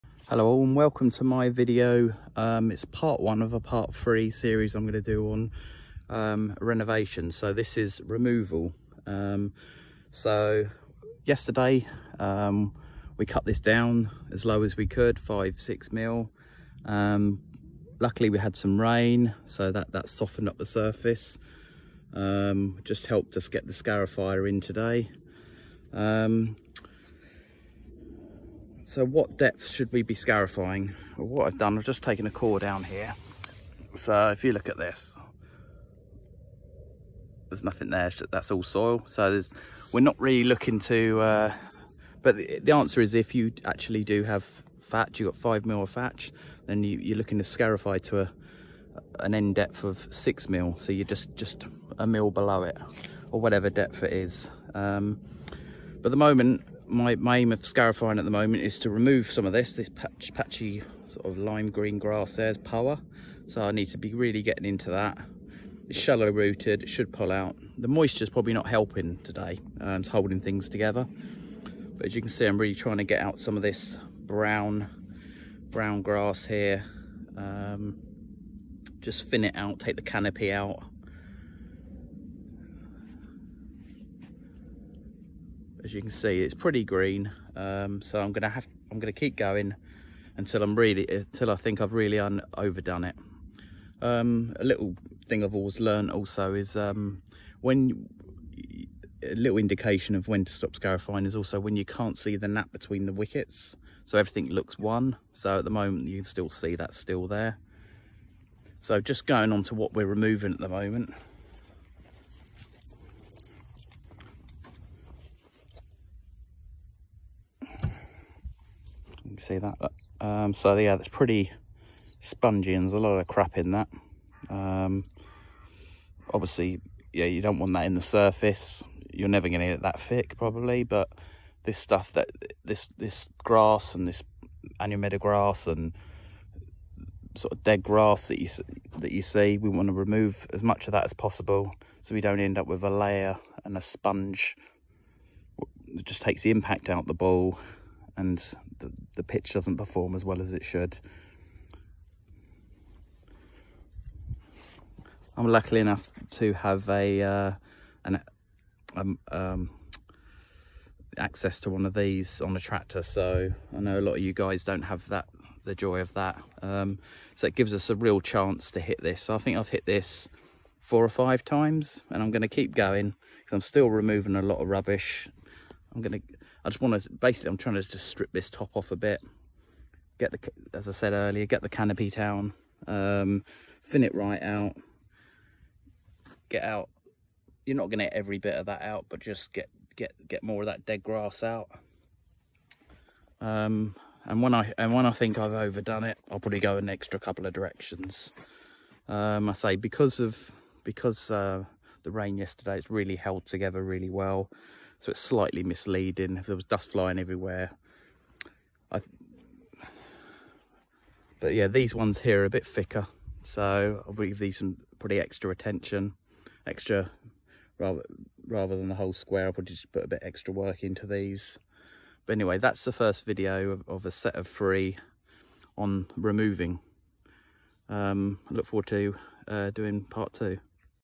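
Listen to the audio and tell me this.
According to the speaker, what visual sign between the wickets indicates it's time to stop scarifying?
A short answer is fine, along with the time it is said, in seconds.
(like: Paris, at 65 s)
can't see the nap, at 101 s.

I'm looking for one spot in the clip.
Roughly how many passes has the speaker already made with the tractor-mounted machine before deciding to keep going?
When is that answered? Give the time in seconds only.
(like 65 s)
170 s.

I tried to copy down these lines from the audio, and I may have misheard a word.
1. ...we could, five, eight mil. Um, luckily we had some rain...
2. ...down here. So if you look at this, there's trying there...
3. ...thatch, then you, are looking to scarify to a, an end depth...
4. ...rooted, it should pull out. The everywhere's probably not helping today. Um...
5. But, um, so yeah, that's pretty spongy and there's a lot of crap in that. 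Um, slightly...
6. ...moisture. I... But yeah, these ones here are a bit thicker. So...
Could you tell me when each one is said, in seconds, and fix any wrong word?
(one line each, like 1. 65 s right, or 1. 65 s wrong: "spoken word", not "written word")
1. 14 s wrong: "six", not "eight"
2. 32 s wrong: "nothing", not "trying"
3. 45 s right
4. 66 s wrong: "moisture", not "everywhere"
5. 119 s wrong: "obviously", not "slightly"
6. 207 s wrong: "everywhere", not "moisture".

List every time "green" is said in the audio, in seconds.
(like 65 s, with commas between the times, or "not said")
61 s, 86 s.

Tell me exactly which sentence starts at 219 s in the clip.
I'll probably just put a bit extra work into these.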